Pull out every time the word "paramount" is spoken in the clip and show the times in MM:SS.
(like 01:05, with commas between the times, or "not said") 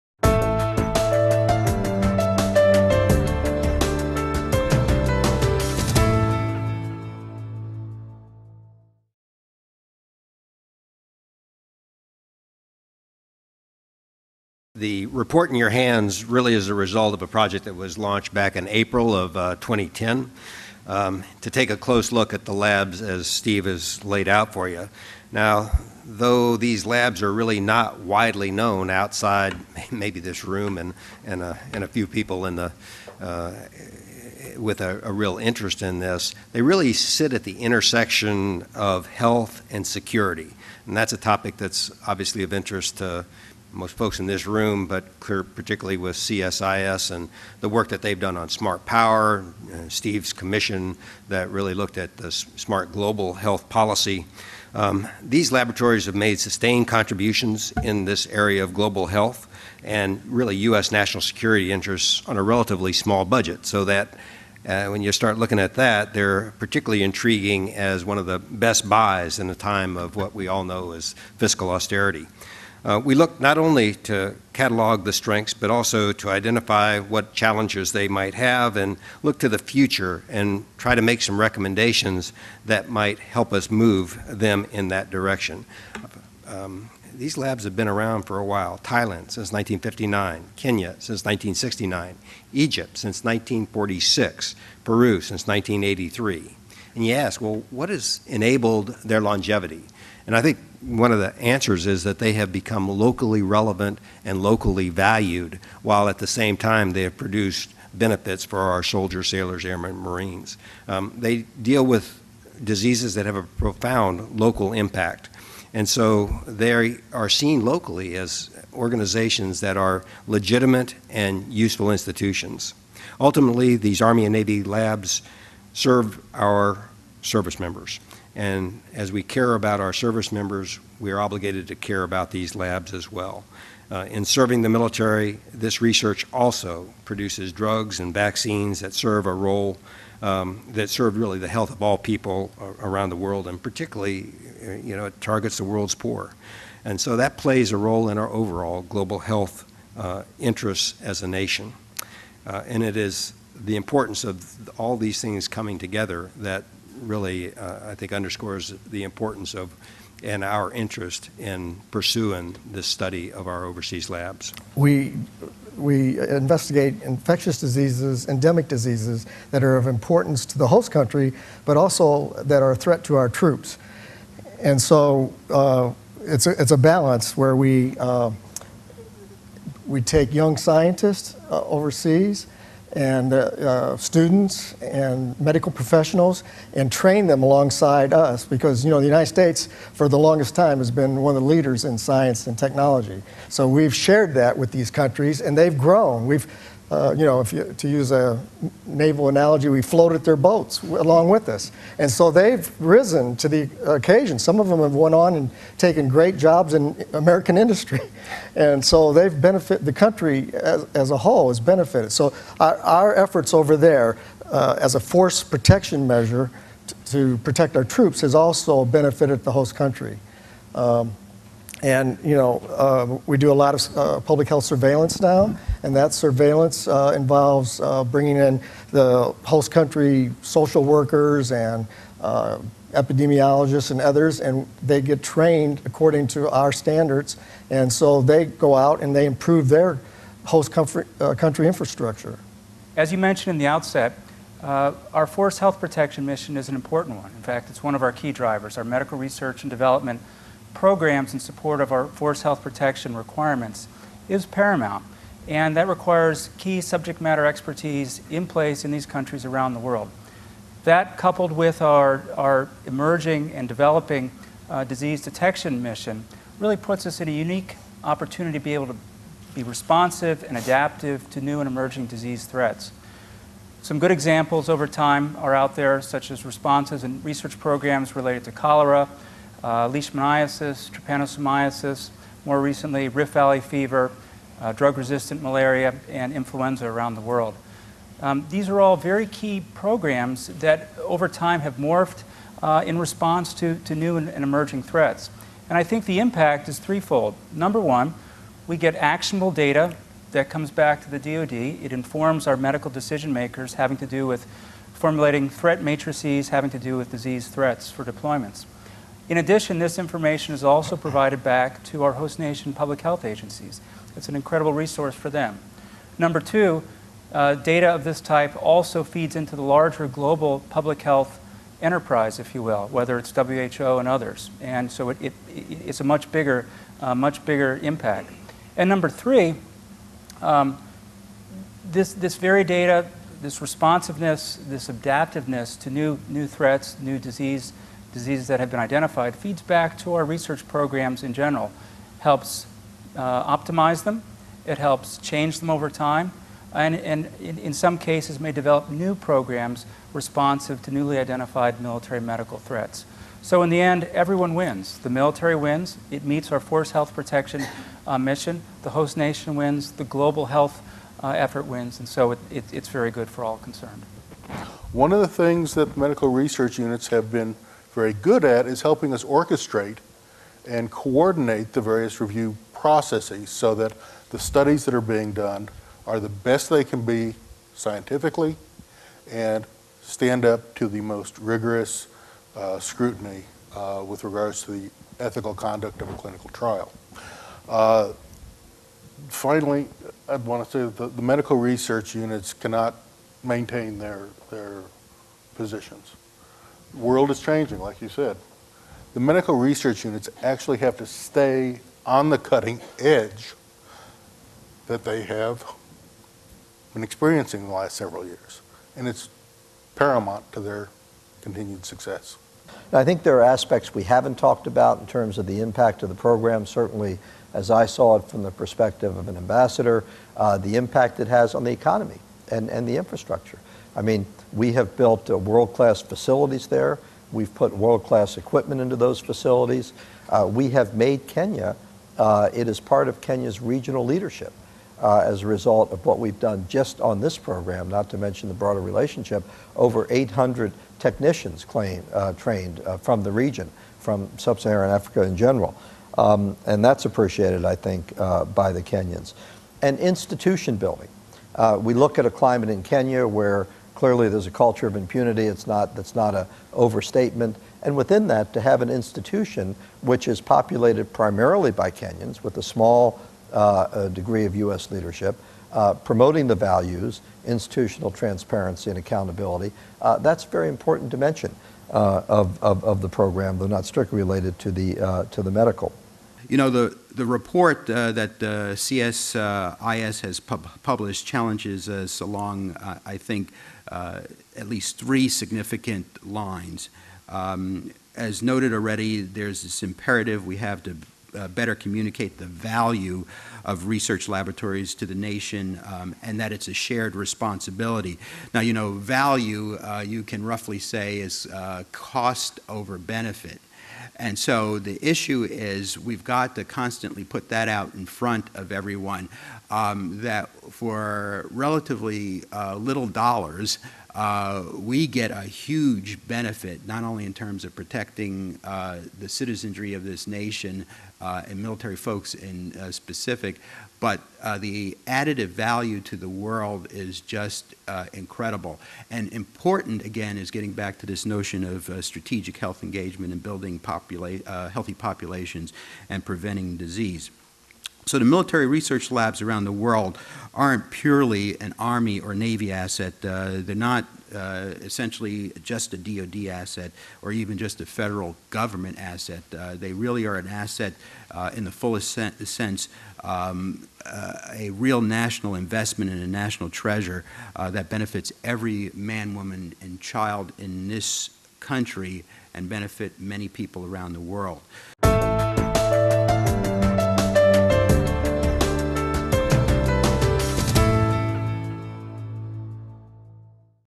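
04:14, 06:49.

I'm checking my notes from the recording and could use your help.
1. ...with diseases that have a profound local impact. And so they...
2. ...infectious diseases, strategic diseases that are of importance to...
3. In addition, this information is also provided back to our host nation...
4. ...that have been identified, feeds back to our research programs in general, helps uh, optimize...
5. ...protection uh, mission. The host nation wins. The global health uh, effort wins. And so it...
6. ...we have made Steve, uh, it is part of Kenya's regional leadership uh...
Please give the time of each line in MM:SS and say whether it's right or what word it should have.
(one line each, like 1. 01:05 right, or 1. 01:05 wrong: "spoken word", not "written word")
1. 01:51 right
2. 02:47 wrong: "endemic", not "strategic"
3. 05:09 right
4. 05:38 right
5. 05:57 right
6. 07:10 wrong: "Kenya", not "Steve".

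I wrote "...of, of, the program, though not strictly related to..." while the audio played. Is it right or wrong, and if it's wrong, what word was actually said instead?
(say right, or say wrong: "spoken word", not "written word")
right.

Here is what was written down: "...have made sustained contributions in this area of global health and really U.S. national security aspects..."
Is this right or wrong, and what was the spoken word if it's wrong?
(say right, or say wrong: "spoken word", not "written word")
wrong: "interests", not "aspects".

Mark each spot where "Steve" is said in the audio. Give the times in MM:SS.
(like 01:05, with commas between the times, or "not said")
00:23, 00:49.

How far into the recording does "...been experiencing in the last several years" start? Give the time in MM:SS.
06:46.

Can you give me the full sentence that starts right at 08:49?
And important, again, is getting back to this notion of strategic health engagement and building popula healthy populations and preventing disease.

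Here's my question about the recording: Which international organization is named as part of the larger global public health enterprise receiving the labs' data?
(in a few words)
WHO.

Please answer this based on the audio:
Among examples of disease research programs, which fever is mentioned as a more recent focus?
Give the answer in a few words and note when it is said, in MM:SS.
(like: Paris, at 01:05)
Rift Valley fever, at 04:43.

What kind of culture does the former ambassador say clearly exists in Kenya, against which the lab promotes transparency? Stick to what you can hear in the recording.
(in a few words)
culture of impunity.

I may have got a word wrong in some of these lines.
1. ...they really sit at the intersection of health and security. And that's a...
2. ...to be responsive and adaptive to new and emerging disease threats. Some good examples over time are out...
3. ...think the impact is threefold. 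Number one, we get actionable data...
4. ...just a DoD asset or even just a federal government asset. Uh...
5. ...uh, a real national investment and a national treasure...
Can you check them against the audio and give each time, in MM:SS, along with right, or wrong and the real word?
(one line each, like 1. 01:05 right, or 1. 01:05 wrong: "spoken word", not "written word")
1. 00:36 right
2. 04:28 right
3. 04:55 right
4. 09:05 right
5. 09:14 right.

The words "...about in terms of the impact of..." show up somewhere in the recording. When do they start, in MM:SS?
06:54.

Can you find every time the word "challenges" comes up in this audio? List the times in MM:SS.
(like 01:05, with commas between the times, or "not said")
01:17, 08:01.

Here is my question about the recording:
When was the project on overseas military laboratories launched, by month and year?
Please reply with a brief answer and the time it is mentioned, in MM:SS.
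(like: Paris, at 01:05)
April 2010, at 00:18.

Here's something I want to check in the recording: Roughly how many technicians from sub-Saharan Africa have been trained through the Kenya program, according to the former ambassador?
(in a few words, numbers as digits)
800.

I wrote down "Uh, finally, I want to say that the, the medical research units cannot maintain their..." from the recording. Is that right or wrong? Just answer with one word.
right.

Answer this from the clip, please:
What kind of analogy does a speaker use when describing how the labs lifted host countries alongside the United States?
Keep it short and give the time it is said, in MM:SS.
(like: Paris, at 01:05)
naval analogy, at 03:18.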